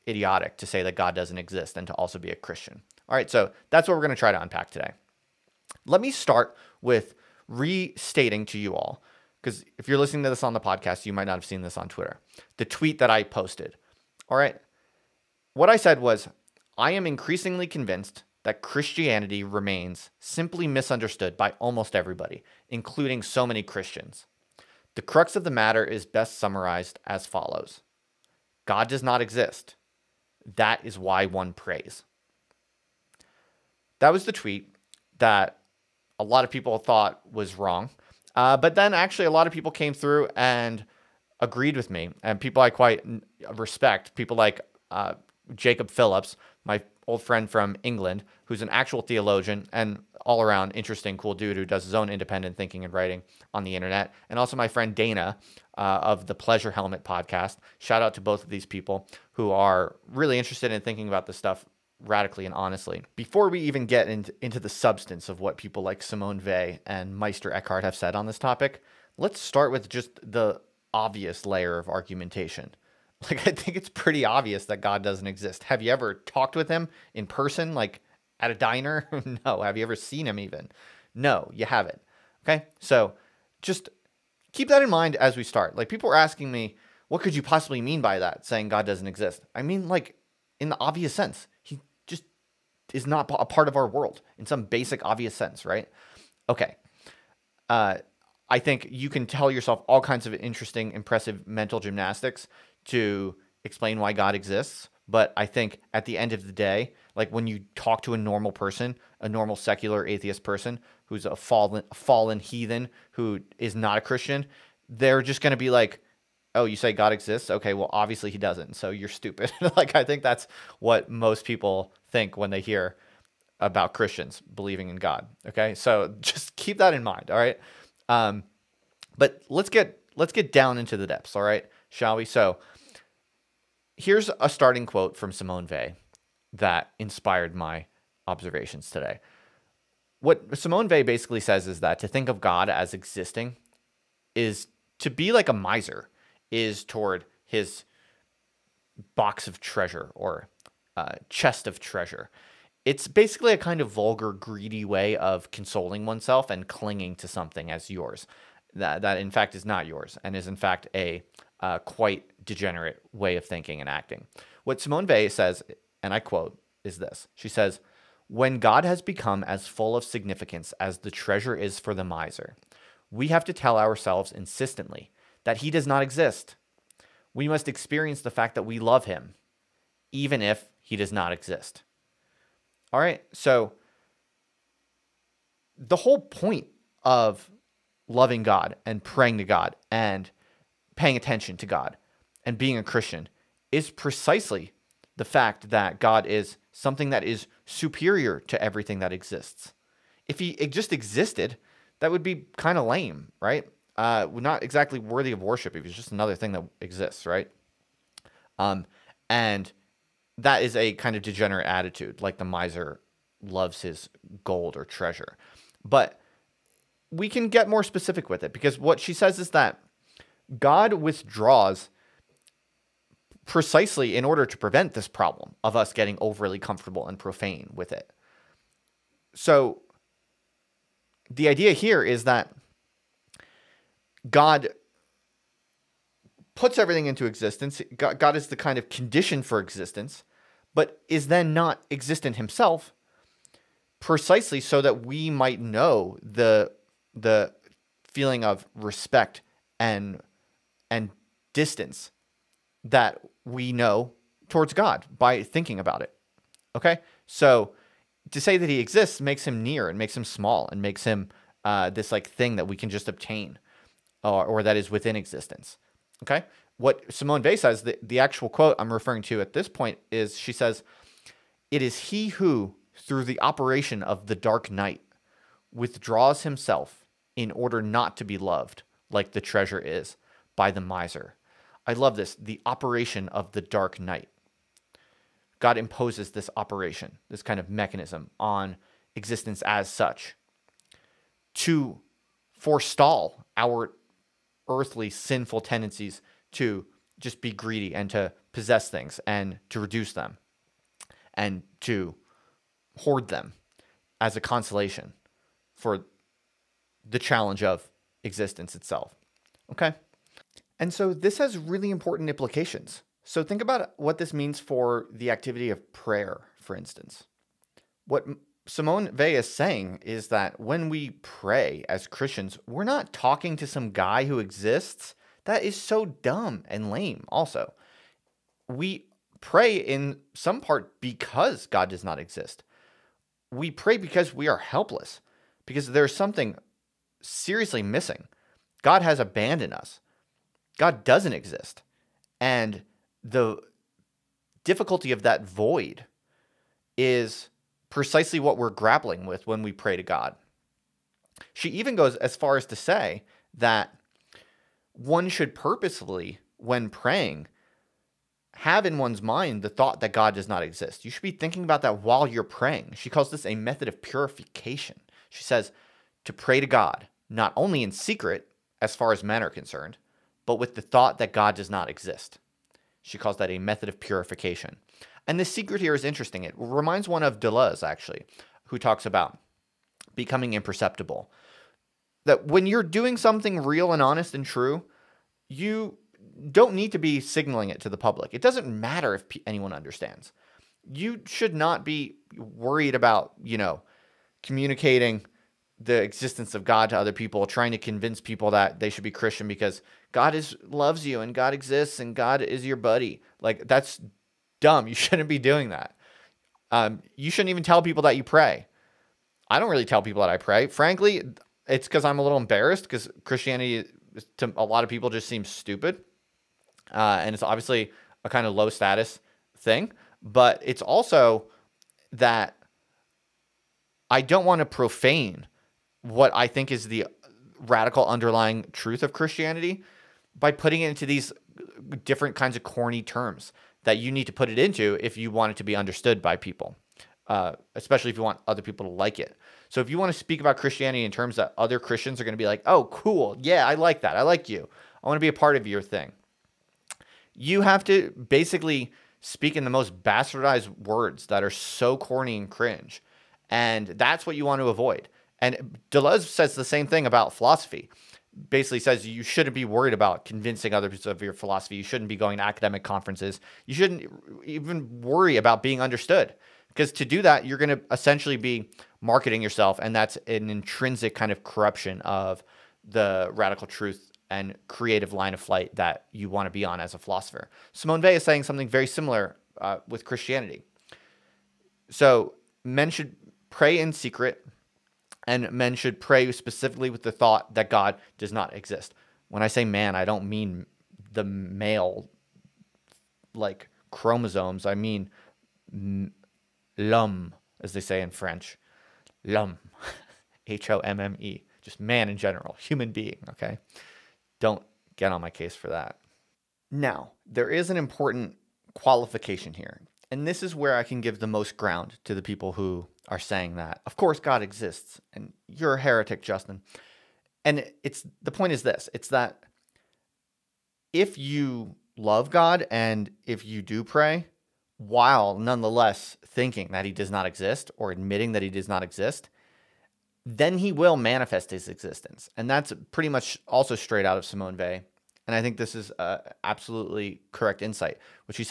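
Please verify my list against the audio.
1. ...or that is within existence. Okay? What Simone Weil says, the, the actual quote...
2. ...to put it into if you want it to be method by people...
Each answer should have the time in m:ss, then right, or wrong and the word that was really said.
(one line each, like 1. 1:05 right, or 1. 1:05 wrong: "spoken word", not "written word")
1. 4:24 right
2. 7:14 wrong: "understood", not "method".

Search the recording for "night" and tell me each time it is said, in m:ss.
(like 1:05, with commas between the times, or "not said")
4:34, 4:44.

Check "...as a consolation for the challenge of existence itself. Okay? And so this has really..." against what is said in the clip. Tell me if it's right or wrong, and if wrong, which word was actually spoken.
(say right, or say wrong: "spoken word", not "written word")
right.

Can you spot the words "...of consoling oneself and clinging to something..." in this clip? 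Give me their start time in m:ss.
2:35.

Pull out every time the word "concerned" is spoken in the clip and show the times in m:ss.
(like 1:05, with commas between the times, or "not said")
6:09.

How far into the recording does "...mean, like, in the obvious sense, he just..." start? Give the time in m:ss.
1:29.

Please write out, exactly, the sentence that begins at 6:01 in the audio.
You should be thinking about that while you're praying.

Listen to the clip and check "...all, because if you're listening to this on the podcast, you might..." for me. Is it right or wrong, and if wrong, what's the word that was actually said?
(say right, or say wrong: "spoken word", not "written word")
right.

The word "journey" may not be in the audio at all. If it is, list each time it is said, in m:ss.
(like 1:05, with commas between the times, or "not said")
not said.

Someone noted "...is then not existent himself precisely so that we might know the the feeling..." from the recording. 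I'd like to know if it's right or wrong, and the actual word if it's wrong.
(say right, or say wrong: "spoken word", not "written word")
right.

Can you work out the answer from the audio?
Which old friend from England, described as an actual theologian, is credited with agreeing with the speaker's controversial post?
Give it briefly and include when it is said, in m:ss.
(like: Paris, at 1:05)
Jacob Phillips, at 0:45.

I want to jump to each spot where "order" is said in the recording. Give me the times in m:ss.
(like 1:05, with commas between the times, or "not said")
3:44, 4:37.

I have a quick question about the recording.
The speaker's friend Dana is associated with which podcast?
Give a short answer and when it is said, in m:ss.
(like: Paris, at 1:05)
Pleasure Helmet, at 0:56.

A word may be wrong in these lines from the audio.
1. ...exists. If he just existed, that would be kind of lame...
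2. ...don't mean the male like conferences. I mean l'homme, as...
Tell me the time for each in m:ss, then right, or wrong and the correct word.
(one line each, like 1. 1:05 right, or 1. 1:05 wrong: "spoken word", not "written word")
1. 3:19 right
2. 8:10 wrong: "chromosomes", not "conferences".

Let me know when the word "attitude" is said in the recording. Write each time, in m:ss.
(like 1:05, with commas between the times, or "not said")
3:31.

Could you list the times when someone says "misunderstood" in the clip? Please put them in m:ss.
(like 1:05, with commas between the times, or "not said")
0:20.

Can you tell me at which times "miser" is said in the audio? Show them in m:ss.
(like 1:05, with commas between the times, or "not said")
2:25, 2:52, 3:32, 4:40.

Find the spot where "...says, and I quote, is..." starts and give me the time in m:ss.
2:45.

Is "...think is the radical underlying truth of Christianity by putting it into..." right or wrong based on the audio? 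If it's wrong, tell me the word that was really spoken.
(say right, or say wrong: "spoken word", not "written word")
right.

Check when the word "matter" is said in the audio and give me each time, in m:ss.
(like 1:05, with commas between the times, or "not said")
0:25, 6:28.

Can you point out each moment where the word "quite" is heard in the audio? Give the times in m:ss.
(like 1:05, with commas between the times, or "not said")
0:42, 2:41.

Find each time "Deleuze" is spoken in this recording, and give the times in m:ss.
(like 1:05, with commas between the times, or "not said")
6:17, 7:35.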